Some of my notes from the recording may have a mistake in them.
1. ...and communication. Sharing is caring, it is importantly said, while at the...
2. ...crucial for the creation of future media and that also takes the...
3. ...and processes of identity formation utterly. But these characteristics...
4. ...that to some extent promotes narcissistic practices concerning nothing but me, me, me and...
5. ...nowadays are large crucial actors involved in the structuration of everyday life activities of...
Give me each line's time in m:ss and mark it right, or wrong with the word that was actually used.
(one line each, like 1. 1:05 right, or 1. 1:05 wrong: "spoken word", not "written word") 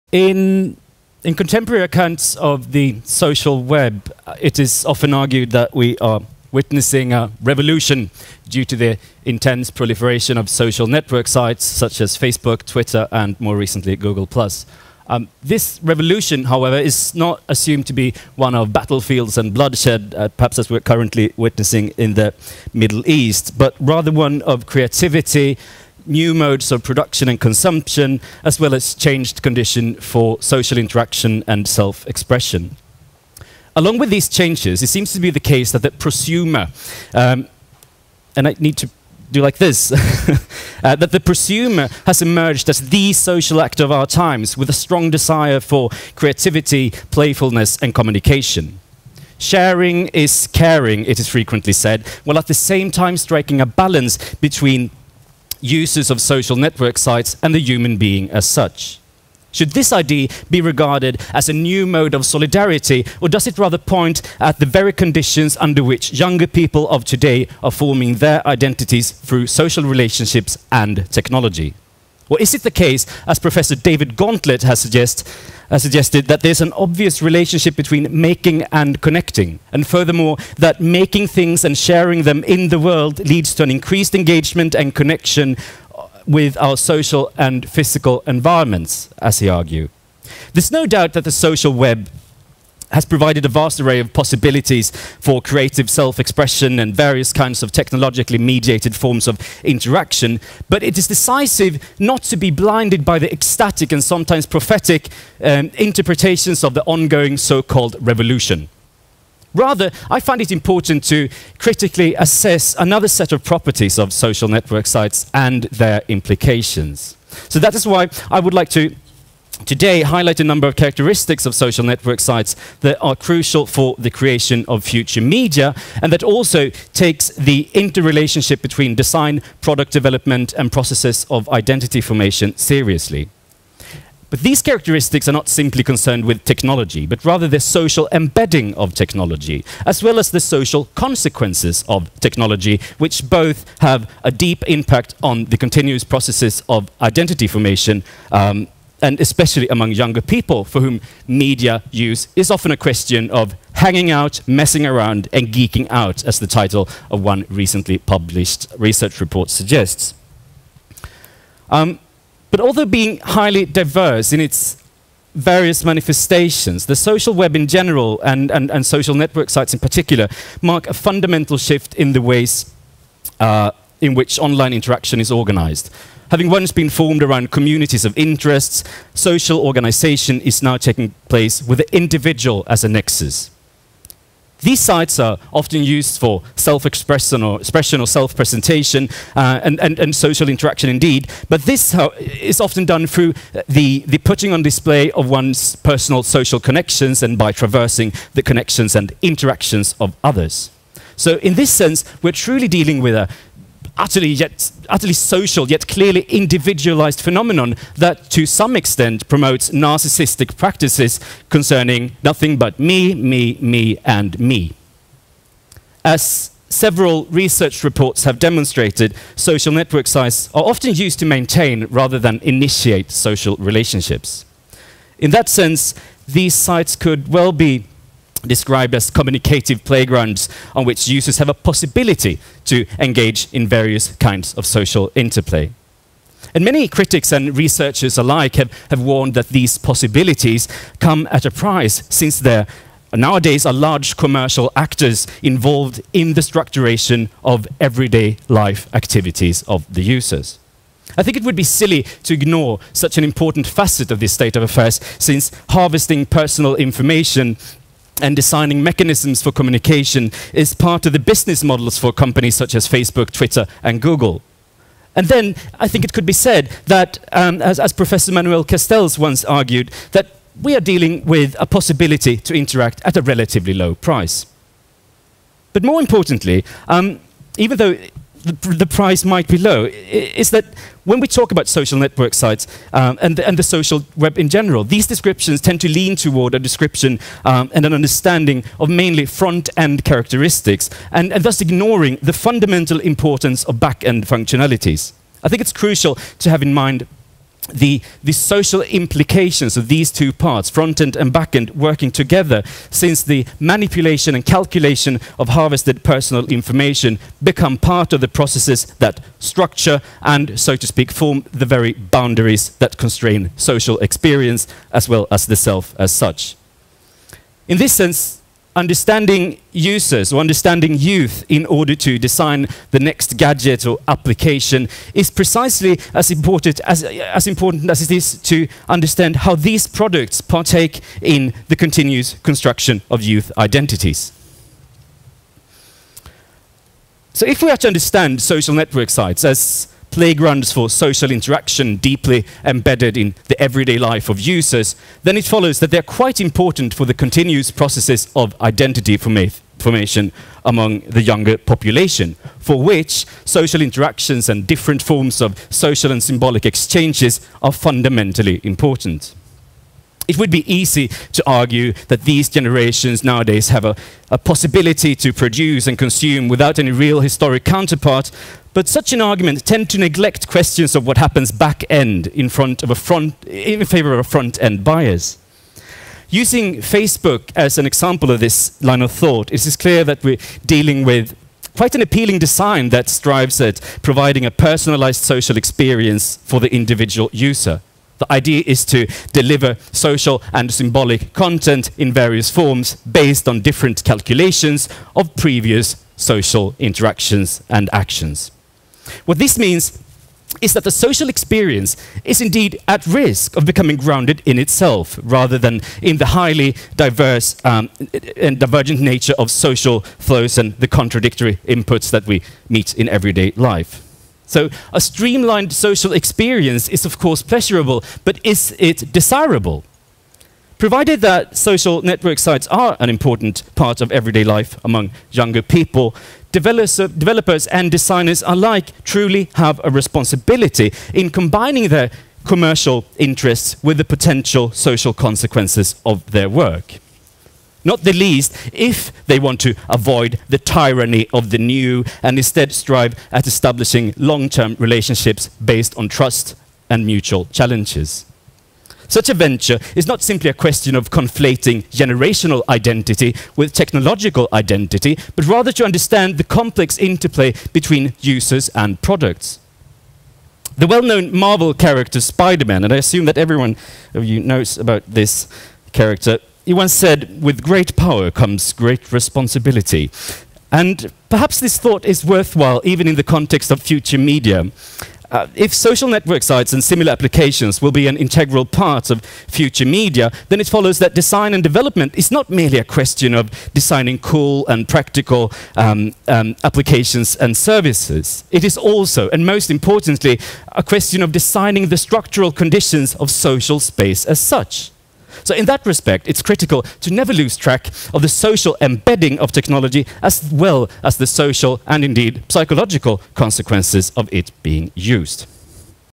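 1. 0:47 wrong: "frequently", not "importantly"
2. 2:03 right
3. 2:10 wrong: "seriously", not "utterly"
4. 3:27 right
5. 4:03 wrong: "commercial", not "crucial".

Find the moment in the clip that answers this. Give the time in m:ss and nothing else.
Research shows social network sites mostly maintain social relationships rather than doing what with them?
3:42.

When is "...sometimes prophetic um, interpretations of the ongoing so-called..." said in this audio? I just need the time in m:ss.
1:44.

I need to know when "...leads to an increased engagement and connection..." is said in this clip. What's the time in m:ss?
1:23.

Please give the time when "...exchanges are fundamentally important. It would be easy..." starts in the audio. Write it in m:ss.
5:56.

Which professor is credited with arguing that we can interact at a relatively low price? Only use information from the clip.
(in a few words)
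Manuel Castells.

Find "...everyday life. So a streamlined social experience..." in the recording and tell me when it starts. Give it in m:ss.
6:53.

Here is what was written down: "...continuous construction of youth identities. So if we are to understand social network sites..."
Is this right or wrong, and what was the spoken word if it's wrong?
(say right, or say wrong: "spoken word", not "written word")
right.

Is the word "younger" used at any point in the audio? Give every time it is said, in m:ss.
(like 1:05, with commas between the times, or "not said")
1:06, 2:29, 5:51, 7:05.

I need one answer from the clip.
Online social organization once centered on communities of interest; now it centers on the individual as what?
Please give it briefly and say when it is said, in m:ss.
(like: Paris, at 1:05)
a nexus, at 3:02.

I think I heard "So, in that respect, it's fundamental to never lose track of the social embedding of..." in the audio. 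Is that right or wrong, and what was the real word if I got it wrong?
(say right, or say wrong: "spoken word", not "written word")
wrong: "critical", not "fundamental".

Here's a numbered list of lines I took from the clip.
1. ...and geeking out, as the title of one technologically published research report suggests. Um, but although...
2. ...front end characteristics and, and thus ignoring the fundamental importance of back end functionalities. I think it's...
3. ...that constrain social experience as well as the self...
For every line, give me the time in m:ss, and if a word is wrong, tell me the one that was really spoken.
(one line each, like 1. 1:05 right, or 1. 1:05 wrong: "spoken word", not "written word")
1. 2:35 wrong: "recently", not "technologically"
2. 4:49 right
3. 5:12 right.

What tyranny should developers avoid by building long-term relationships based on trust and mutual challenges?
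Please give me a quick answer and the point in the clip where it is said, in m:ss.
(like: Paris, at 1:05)
the tyranny of the new, at 7:20.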